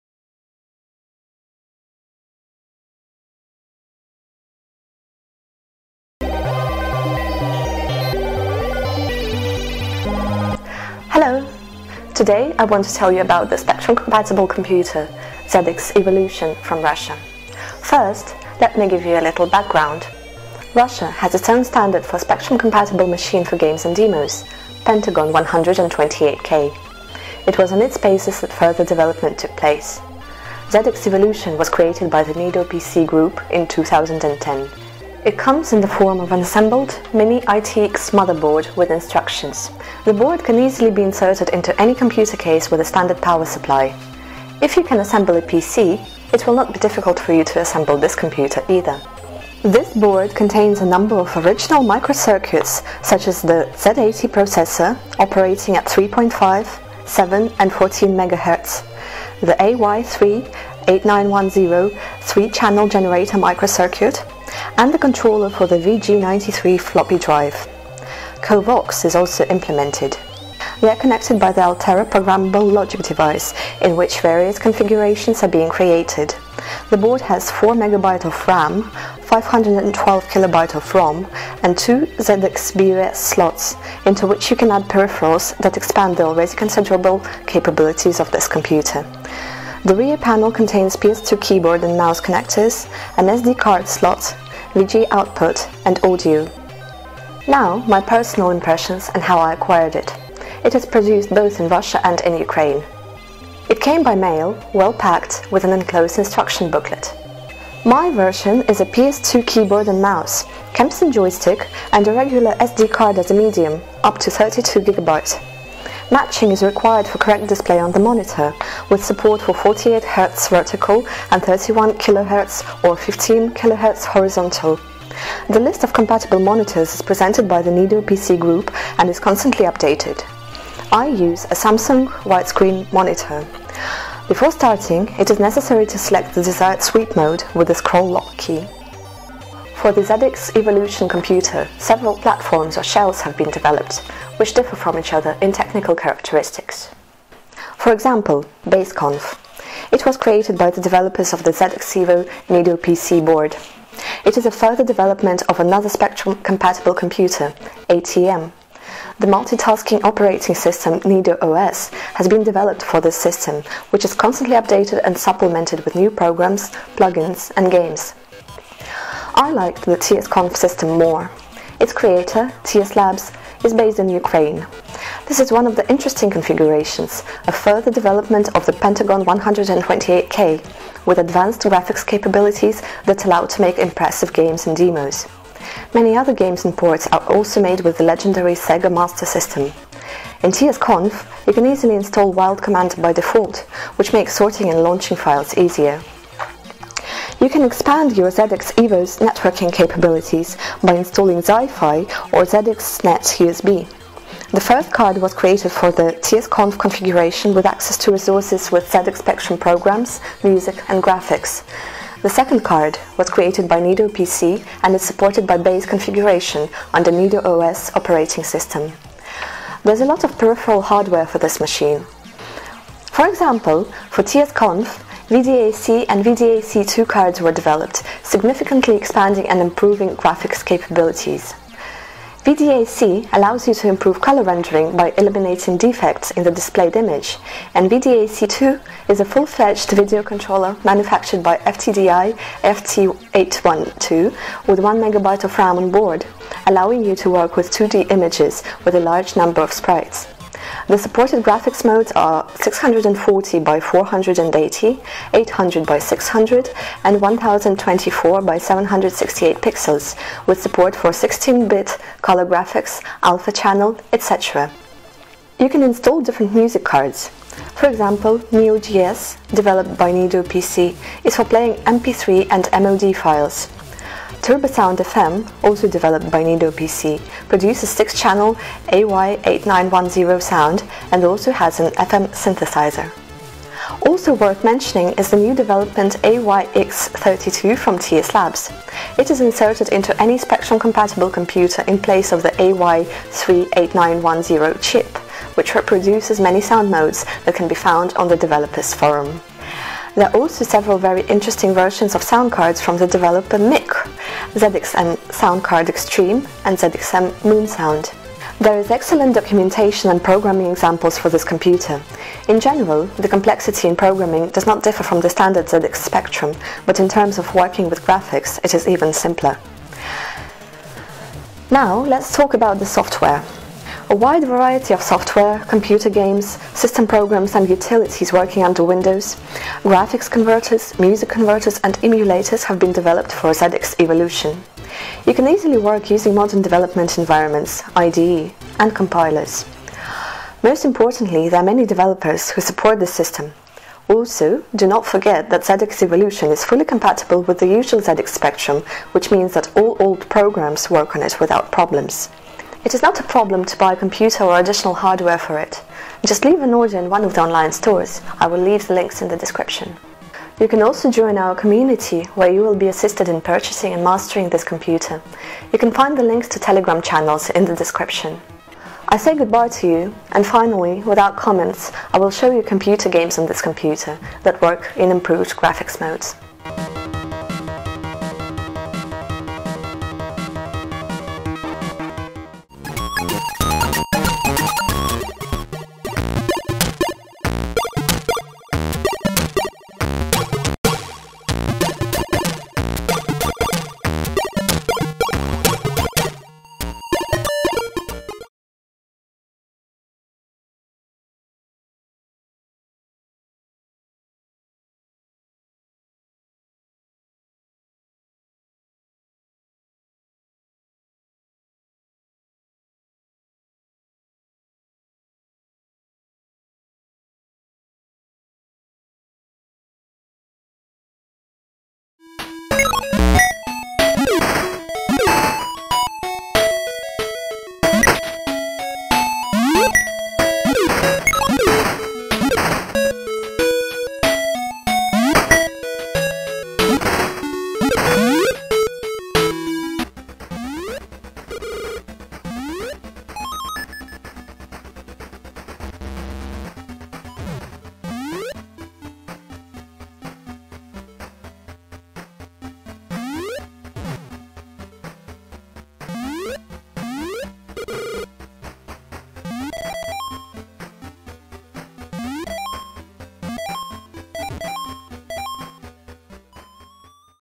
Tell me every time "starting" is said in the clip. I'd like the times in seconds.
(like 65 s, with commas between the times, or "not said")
134 s.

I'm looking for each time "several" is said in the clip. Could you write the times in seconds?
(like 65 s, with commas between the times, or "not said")
141 s, 300 s.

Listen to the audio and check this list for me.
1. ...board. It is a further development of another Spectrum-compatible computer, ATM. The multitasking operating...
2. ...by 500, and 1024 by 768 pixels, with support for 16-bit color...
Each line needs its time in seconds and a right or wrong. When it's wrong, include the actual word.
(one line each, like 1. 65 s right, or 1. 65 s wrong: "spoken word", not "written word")
1. 153 s right
2. 255 s wrong: "600", not "500".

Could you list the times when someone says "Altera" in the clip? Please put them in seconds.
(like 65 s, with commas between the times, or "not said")
71 s.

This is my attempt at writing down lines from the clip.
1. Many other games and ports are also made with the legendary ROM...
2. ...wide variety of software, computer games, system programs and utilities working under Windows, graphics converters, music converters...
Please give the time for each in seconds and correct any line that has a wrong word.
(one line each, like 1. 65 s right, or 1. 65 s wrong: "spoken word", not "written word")
1. 185 s wrong: "Sega", not "ROM"
2. 324 s right.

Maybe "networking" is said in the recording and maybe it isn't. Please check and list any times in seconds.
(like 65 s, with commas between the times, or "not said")
199 s.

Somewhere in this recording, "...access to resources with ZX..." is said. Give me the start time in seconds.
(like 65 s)
207 s.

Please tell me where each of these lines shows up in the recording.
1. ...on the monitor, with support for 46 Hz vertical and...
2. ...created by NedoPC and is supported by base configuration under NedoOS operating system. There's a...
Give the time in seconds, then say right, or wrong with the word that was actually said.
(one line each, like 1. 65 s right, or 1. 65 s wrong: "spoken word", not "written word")
1. 117 s wrong: "48", not "46"
2. 213 s right.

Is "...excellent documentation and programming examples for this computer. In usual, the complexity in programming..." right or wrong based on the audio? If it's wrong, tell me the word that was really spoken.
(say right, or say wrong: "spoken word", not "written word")
wrong: "general", not "usual".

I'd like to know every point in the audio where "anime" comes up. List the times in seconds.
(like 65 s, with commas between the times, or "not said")
not said.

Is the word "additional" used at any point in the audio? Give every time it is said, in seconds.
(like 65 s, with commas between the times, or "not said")
354 s.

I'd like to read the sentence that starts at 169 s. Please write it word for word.
I liked the TSConf system more.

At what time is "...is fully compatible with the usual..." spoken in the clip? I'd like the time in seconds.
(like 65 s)
346 s.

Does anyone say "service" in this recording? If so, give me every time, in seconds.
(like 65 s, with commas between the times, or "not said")
not said.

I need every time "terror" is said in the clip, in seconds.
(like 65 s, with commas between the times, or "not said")
not said.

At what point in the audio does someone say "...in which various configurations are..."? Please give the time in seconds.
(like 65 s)
73 s.